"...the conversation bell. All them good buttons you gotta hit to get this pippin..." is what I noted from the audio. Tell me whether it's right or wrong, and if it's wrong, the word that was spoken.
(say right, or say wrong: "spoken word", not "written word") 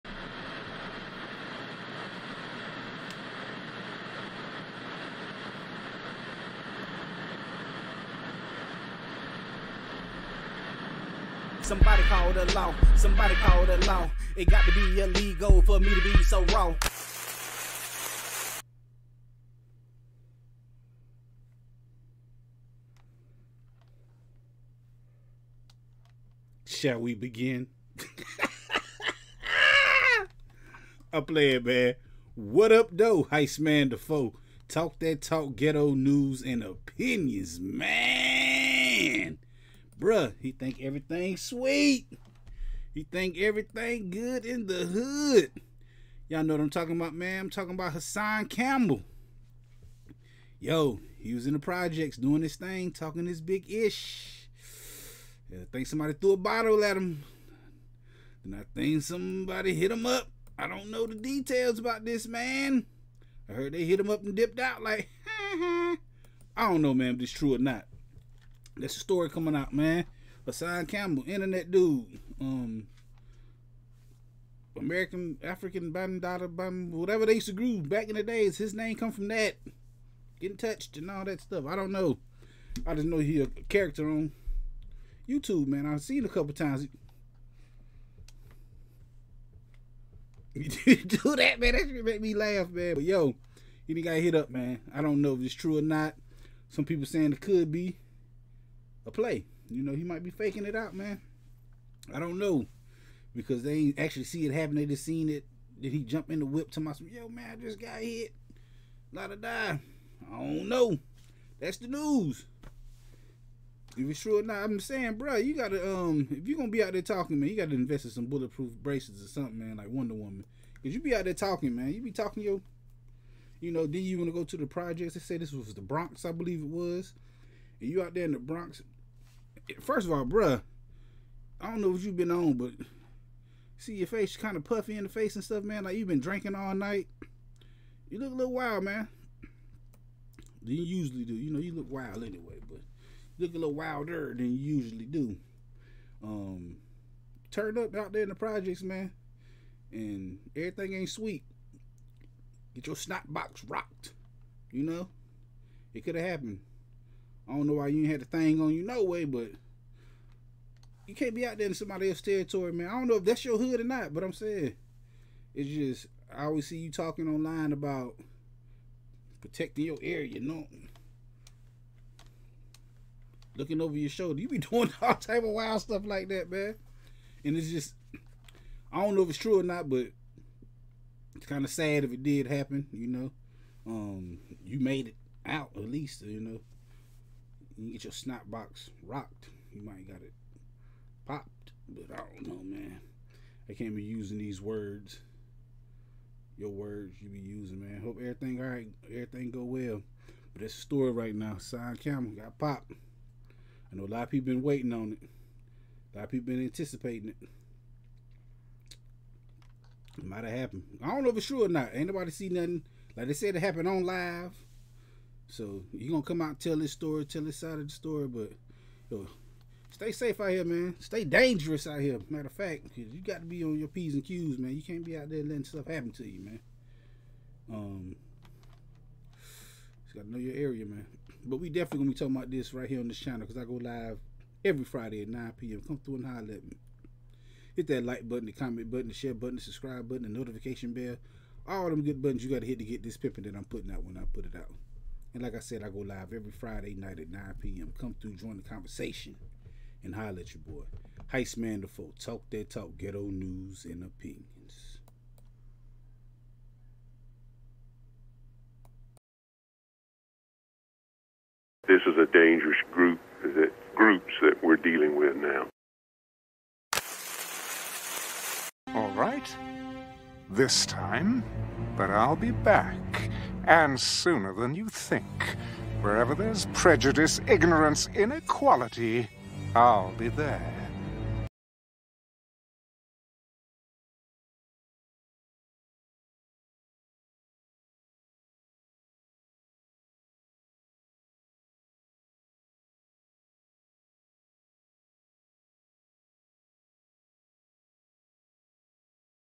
wrong: "notification", not "conversation".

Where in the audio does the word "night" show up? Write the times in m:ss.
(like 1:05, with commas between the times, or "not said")
2:16, 4:06.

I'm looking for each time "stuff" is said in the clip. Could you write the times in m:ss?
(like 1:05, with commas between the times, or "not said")
1:21, 2:15, 2:55, 3:45.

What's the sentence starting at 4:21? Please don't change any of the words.
This is a dangerous group that groups that we're dealing with now.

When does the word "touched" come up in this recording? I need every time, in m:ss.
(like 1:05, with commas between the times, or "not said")
1:20.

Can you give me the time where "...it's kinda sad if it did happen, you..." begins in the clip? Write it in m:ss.
3:01.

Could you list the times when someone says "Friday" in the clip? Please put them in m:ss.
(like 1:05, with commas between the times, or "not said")
3:54, 4:06.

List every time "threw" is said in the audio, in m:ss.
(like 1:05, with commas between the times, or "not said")
0:56.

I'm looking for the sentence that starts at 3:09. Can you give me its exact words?
You might got it popped, but I don't know, man.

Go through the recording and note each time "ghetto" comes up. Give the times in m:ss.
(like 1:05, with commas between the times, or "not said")
0:35, 4:12.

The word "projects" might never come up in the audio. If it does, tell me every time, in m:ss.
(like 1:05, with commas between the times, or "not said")
0:51, 2:04, 2:28.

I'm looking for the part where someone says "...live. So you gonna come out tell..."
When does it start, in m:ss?
3:34.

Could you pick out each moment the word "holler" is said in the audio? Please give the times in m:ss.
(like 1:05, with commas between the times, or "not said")
3:56, 4:10.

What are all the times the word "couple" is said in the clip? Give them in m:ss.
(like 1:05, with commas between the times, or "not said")
1:26.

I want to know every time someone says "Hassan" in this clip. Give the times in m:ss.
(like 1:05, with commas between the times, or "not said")
0:47, 1:10, 3:21.